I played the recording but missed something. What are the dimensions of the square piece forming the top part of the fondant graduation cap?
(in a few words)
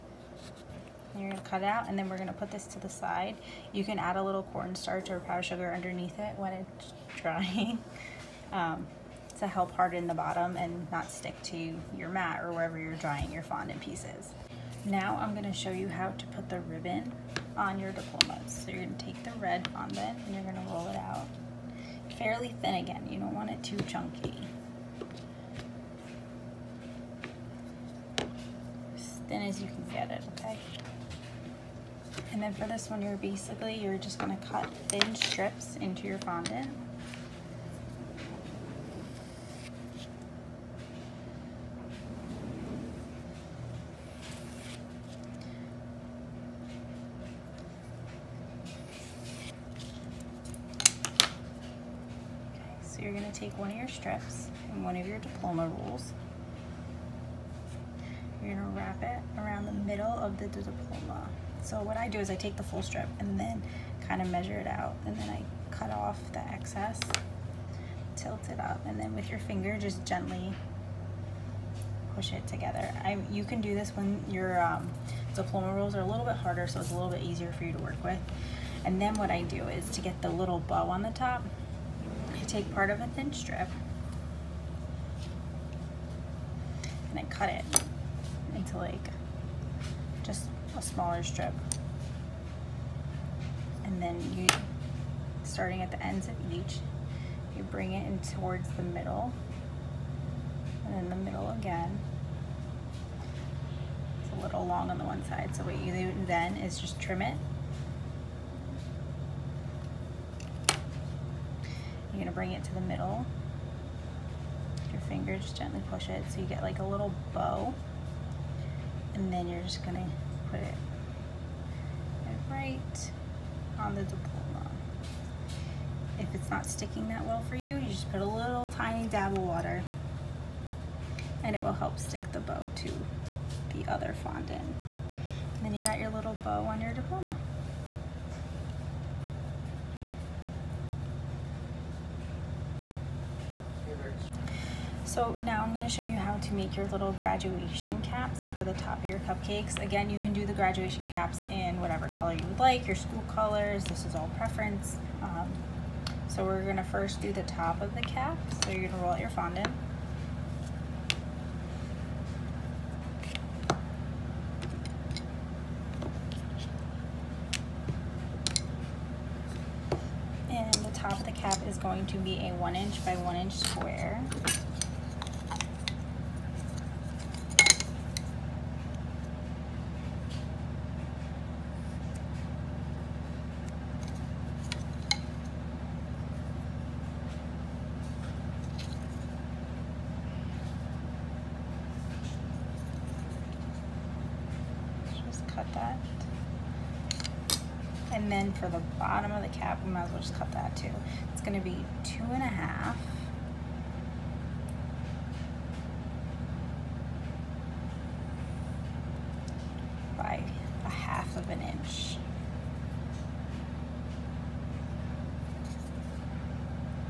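1 inch by 1 inch.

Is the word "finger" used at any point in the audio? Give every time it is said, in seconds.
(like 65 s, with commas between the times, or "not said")
69 s, 115 s.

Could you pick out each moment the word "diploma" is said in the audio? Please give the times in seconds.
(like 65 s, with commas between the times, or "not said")
17 s, 55 s, 60 s, 75 s, 124 s, 136 s.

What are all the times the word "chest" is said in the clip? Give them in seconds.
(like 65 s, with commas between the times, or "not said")
not said.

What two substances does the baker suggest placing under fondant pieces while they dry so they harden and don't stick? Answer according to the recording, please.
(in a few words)
cornstarch or powdered sugar.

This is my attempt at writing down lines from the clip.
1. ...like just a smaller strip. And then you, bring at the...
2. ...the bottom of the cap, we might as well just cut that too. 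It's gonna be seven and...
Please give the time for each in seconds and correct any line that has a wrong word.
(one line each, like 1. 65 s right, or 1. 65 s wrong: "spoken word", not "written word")
1. 88 s wrong: "starting", not "bring"
2. 198 s wrong: "two", not "seven".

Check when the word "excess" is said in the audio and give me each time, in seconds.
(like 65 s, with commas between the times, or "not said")
66 s.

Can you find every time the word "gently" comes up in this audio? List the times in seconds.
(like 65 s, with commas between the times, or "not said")
70 s, 115 s.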